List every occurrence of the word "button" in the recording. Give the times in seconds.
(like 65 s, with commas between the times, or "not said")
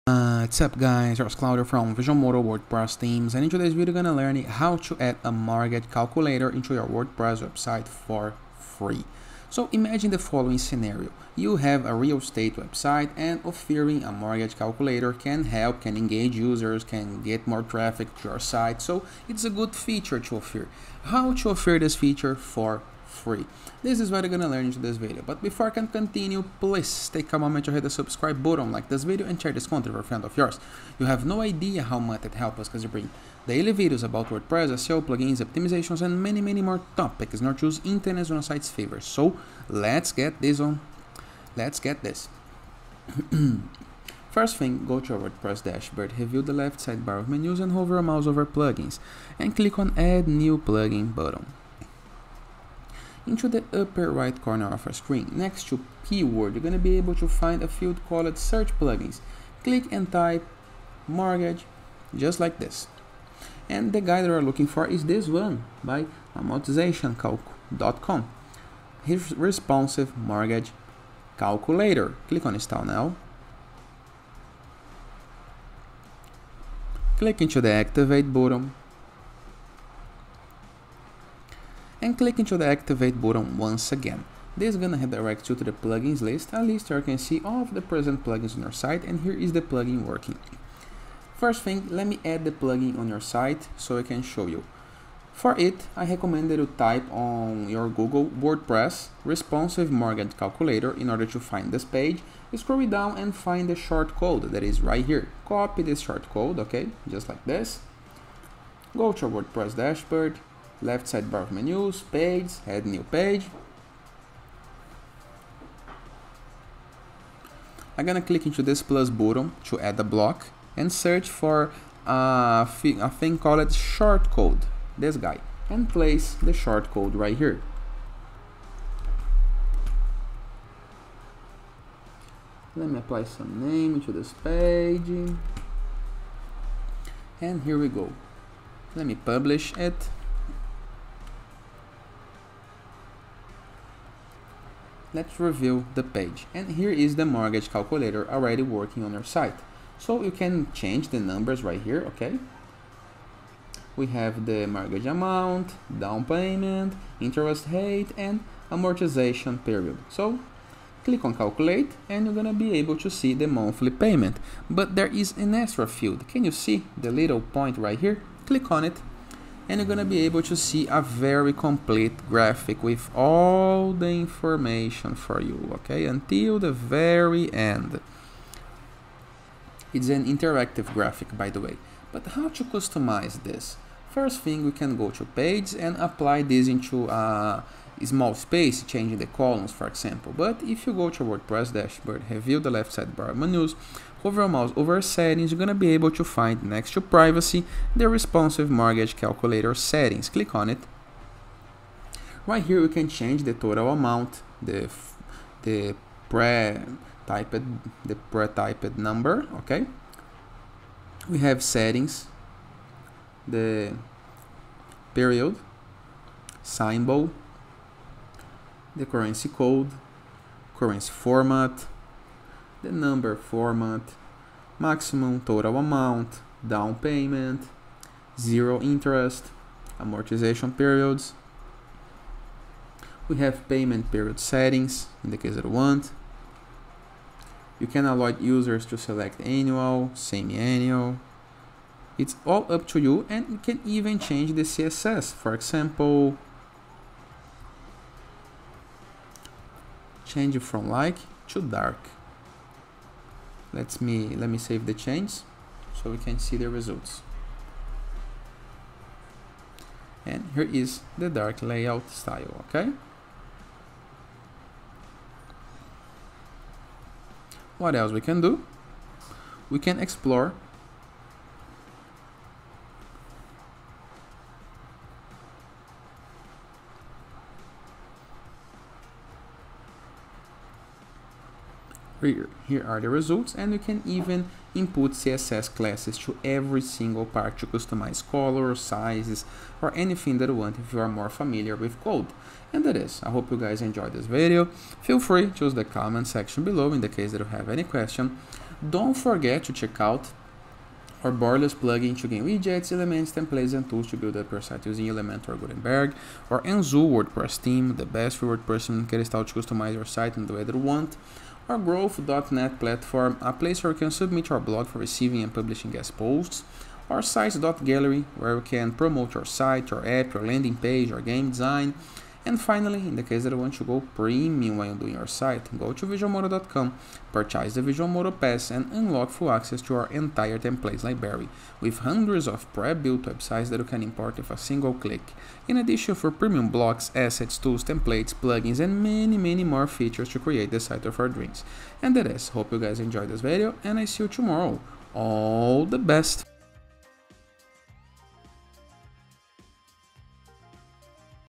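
28 s, 51 s, 78 s, 83 s, 119 s.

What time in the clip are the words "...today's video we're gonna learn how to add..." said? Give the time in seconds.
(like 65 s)
3 s.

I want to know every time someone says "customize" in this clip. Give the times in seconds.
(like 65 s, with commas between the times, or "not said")
182 s, 287 s, 309 s.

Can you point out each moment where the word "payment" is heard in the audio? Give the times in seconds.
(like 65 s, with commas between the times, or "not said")
156 s, 163 s, 226 s, 233 s.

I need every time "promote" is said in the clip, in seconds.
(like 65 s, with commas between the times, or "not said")
318 s.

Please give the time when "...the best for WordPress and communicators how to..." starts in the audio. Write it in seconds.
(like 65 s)
307 s.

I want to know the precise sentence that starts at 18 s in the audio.
So it's a good feature to offer.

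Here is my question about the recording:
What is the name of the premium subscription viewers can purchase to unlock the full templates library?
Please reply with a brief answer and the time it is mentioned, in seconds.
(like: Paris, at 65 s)
Visualmodo Pass, at 327 s.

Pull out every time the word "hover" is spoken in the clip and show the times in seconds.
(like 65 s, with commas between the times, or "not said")
47 s, 194 s.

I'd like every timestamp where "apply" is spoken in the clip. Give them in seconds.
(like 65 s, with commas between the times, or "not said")
132 s, 185 s.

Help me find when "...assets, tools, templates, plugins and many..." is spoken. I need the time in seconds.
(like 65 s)
337 s.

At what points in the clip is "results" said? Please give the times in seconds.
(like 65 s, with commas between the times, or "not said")
256 s, 283 s.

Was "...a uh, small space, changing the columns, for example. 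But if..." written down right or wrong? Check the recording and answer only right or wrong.
right.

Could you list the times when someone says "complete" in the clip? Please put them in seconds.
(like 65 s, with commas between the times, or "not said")
171 s.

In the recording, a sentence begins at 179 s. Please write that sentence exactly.
It's an interactive graphic, by the way.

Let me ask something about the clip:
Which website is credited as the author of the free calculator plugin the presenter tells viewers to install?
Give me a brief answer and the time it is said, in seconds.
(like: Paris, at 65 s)
amortizationcalc.com, at 66 s.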